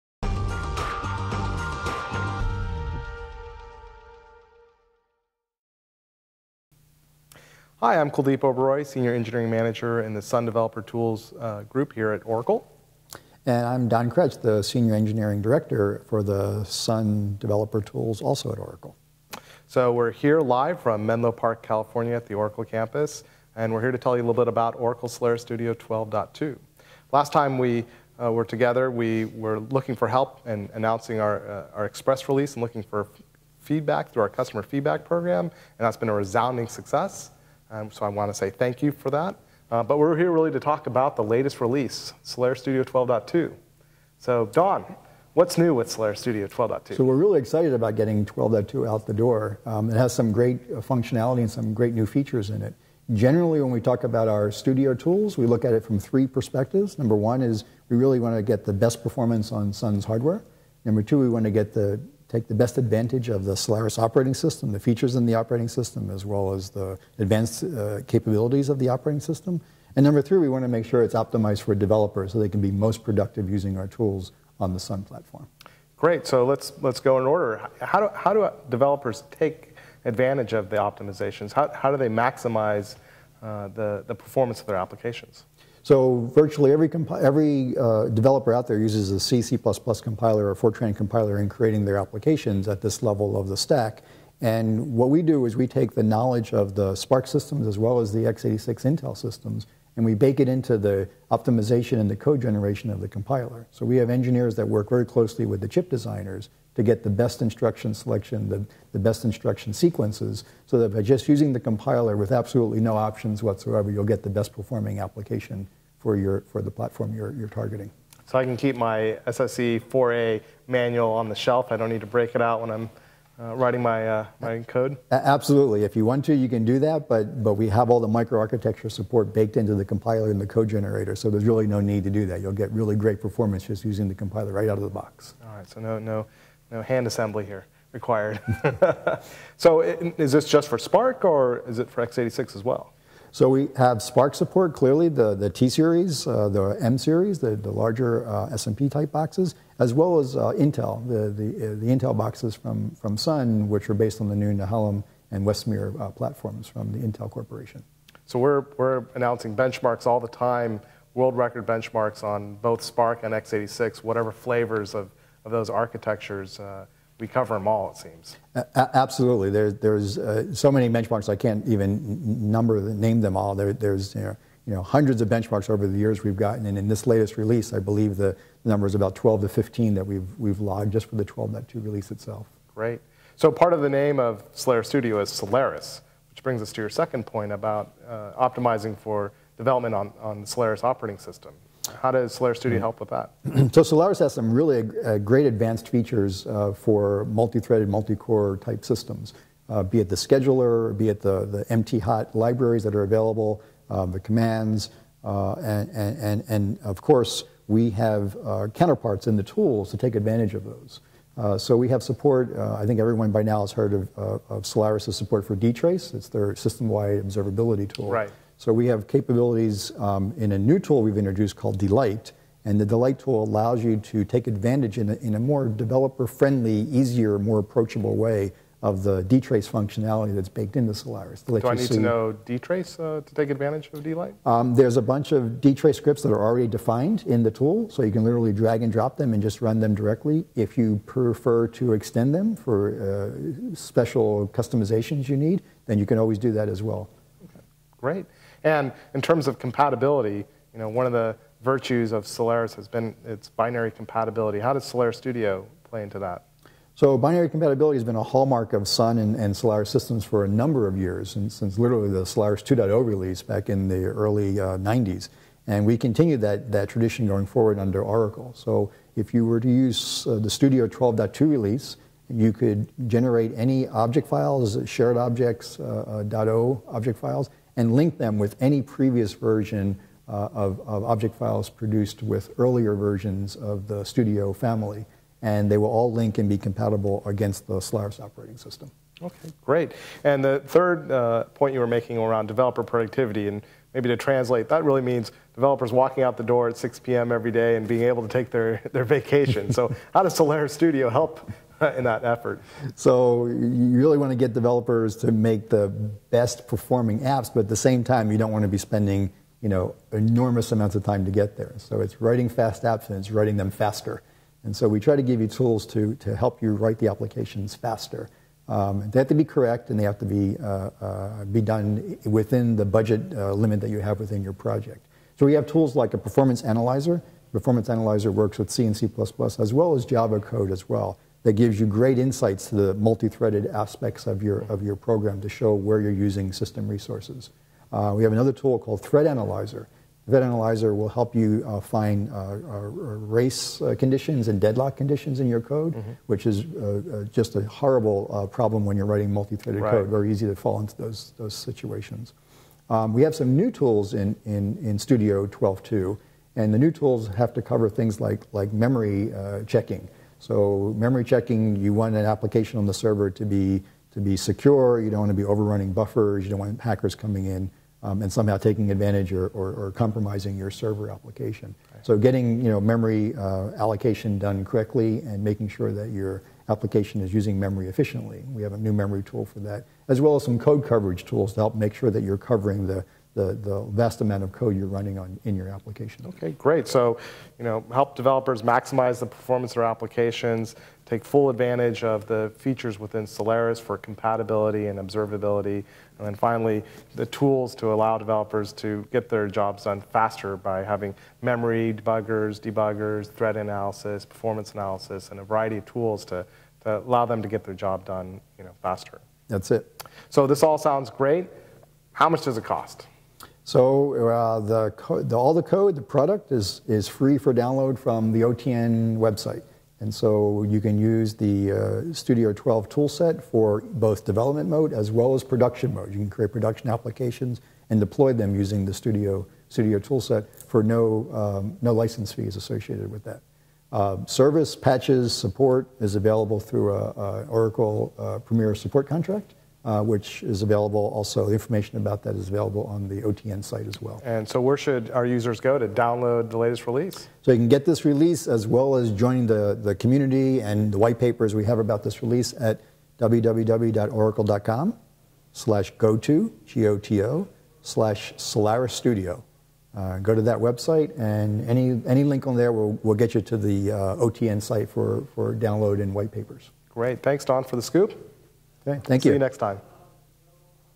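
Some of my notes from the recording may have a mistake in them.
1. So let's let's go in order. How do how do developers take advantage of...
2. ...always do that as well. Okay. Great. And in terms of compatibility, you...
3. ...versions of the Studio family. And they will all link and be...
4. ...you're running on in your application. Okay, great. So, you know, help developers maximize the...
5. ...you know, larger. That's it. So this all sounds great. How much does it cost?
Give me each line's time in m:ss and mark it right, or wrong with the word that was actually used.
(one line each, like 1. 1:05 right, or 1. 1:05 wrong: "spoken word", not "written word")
1. 1:16 right
2. 4:06 right
3. 4:42 right
4. 6:24 right
5. 6:48 wrong: "faster", not "larger".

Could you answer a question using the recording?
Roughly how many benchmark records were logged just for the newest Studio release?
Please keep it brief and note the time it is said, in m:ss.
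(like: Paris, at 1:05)
12 to 15, at 2:59.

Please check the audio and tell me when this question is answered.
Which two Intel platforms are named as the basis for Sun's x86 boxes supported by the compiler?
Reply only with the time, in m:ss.
2:34.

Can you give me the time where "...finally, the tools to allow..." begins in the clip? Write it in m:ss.
6:36.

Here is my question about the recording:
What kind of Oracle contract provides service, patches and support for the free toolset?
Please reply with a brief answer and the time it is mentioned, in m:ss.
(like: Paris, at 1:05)
Premier support, at 7:18.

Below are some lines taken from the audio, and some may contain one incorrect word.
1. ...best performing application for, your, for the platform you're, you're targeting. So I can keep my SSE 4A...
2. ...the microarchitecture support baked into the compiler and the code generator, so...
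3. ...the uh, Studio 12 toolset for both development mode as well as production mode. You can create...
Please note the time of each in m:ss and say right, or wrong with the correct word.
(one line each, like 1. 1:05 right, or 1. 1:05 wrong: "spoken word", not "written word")
1. 1:54 right
2. 2:07 right
3. 7:01 right.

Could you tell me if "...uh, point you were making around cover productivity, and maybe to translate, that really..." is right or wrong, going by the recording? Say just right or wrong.
wrong.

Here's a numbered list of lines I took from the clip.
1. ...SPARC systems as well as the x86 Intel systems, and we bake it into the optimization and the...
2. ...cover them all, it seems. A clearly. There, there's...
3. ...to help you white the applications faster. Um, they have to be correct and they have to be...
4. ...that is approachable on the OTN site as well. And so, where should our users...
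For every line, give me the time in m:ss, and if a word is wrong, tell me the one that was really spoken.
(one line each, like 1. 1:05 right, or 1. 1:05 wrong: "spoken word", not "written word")
1. 1:36 right
2. 2:47 wrong: "absolutely", not "clearly"
3. 5:16 wrong: "write", not "white"
4. 7:22 wrong: "available", not "approachable".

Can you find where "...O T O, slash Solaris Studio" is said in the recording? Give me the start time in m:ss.
7:36.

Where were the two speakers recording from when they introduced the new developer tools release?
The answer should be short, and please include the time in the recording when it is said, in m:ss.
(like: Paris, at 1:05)
Menlo Park, California, at 0:21.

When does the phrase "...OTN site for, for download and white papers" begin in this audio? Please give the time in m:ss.
7:44.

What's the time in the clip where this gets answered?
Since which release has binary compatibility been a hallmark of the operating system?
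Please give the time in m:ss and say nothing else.
4:22.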